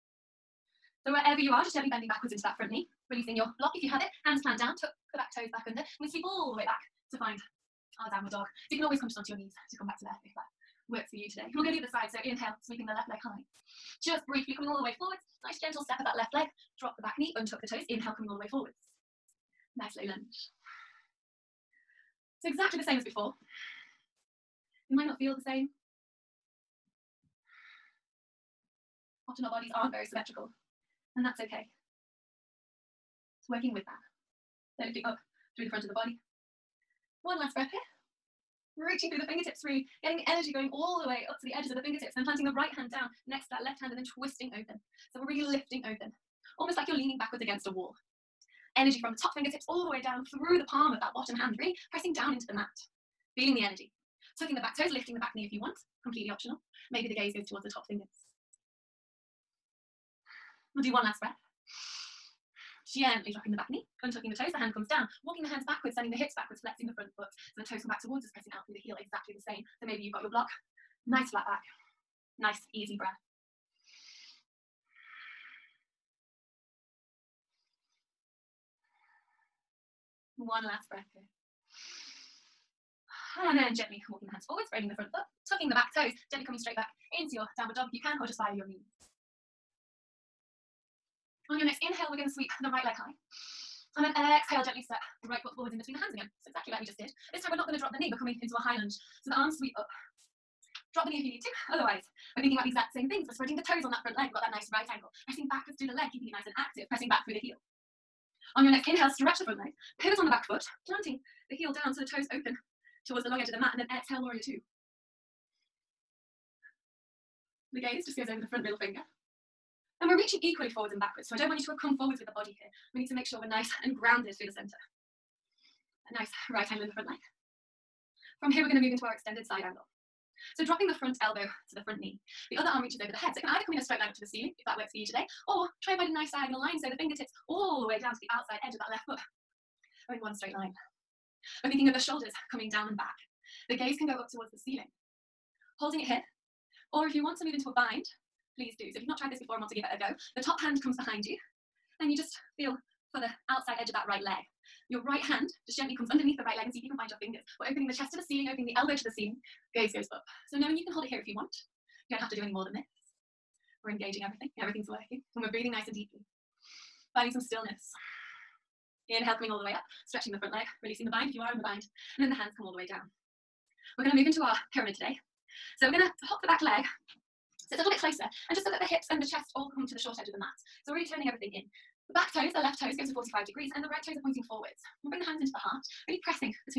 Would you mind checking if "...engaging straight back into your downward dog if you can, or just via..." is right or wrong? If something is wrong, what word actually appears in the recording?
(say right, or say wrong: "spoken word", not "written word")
wrong: "coming", not "engaging".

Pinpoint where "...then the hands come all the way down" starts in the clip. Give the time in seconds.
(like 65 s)
172 s.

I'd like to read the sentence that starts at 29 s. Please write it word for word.
Often our bodies aren't very symmetrical, and that's okay.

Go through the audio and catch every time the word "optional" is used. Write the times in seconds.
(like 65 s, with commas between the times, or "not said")
56 s.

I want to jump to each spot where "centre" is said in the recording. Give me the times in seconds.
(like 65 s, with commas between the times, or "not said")
124 s.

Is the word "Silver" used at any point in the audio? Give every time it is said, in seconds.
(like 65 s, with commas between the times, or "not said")
not said.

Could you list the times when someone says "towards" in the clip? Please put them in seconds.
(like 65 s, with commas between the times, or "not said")
57 s, 68 s, 113 s, 144 s.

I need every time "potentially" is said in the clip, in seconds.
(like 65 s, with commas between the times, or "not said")
not said.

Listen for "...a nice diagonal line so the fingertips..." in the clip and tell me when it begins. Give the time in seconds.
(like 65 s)
136 s.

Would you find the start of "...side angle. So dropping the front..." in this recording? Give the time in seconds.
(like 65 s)
129 s.